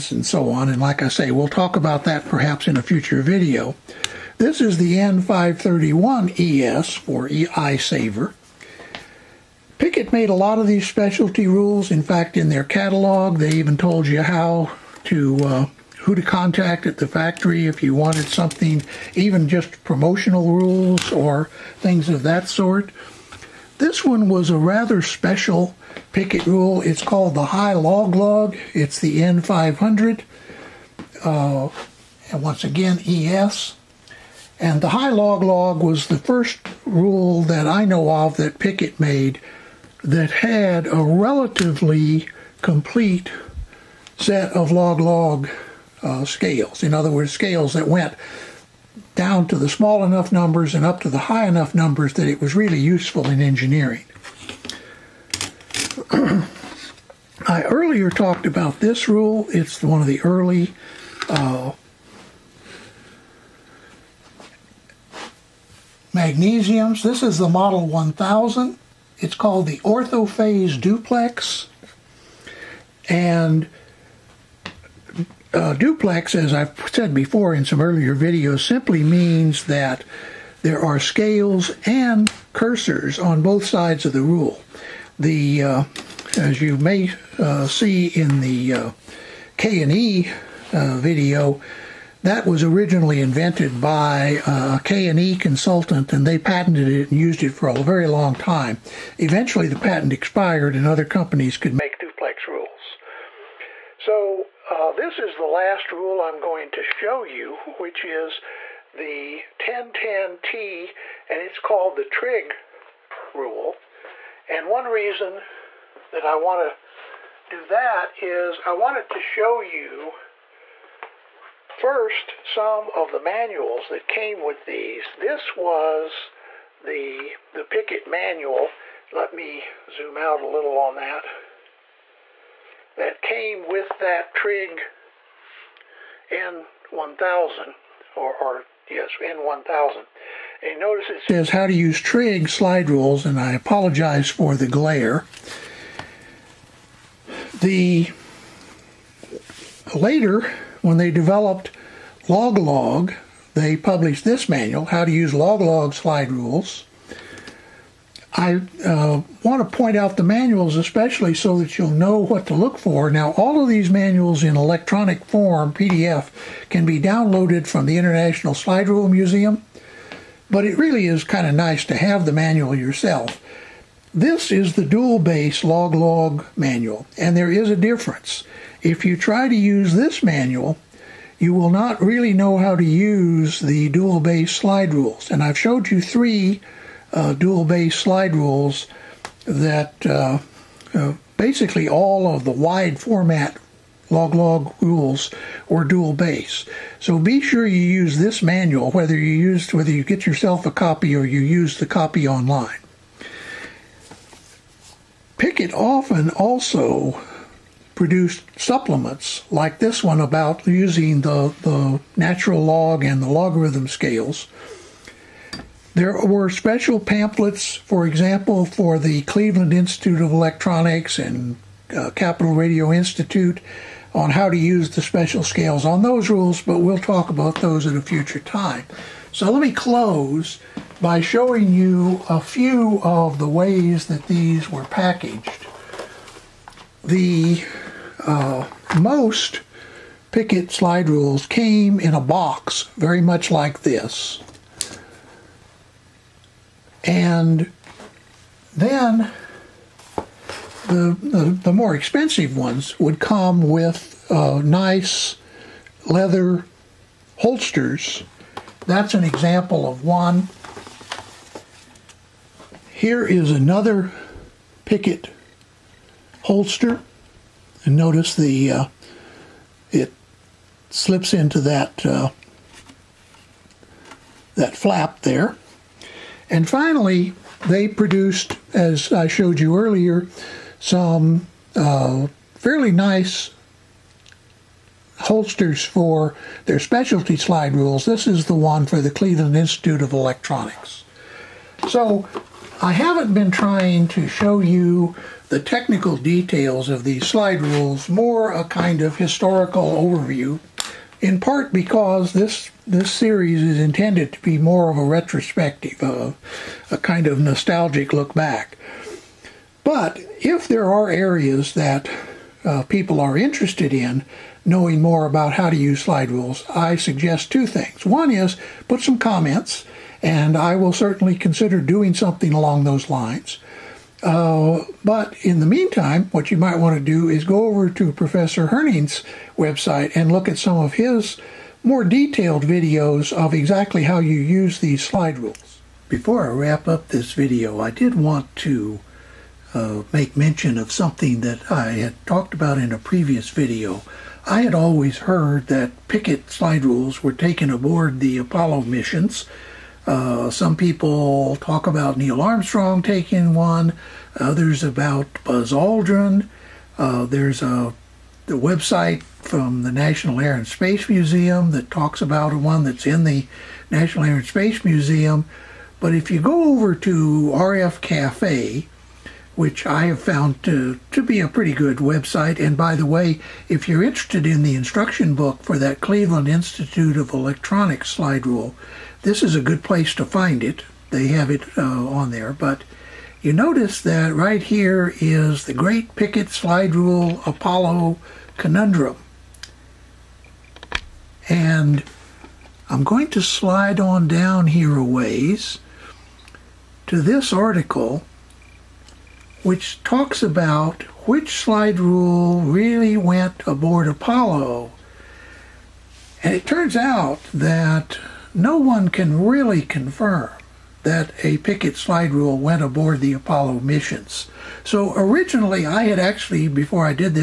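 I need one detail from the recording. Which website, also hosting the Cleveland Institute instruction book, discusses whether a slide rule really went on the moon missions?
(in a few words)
RF Cafe.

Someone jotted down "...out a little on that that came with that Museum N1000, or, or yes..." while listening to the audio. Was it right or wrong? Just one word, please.
wrong.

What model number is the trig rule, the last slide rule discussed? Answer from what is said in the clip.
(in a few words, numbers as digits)
1010T.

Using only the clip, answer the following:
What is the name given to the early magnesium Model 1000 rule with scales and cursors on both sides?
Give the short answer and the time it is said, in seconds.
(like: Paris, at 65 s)
orthophase duplex, at 69 s.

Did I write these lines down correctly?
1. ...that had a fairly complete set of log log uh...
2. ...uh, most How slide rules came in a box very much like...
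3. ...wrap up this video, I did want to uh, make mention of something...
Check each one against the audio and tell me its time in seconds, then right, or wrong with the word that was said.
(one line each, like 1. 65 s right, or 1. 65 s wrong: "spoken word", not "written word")
1. 40 s wrong: "relatively", not "fairly"
2. 238 s wrong: "Pickett", not "How"
3. 336 s right.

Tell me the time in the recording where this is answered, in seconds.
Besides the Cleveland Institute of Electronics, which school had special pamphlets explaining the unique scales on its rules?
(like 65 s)
222 s.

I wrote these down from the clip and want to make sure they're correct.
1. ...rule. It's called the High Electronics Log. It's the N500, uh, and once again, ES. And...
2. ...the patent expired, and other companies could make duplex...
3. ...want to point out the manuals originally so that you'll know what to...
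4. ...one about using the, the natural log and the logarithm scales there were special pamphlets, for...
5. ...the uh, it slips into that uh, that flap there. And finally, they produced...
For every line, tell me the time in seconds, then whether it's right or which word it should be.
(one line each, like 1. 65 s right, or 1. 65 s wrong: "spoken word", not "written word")
1. 26 s wrong: "Log", not "Electronics"
2. 99 s right
3. 159 s wrong: "especially", not "originally"
4. 210 s right
5. 268 s right.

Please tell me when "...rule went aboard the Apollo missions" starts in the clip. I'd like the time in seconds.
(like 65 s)
412 s.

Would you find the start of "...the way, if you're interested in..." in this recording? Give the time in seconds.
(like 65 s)
372 s.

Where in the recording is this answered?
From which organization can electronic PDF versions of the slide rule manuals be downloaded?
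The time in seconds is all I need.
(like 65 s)
167 s.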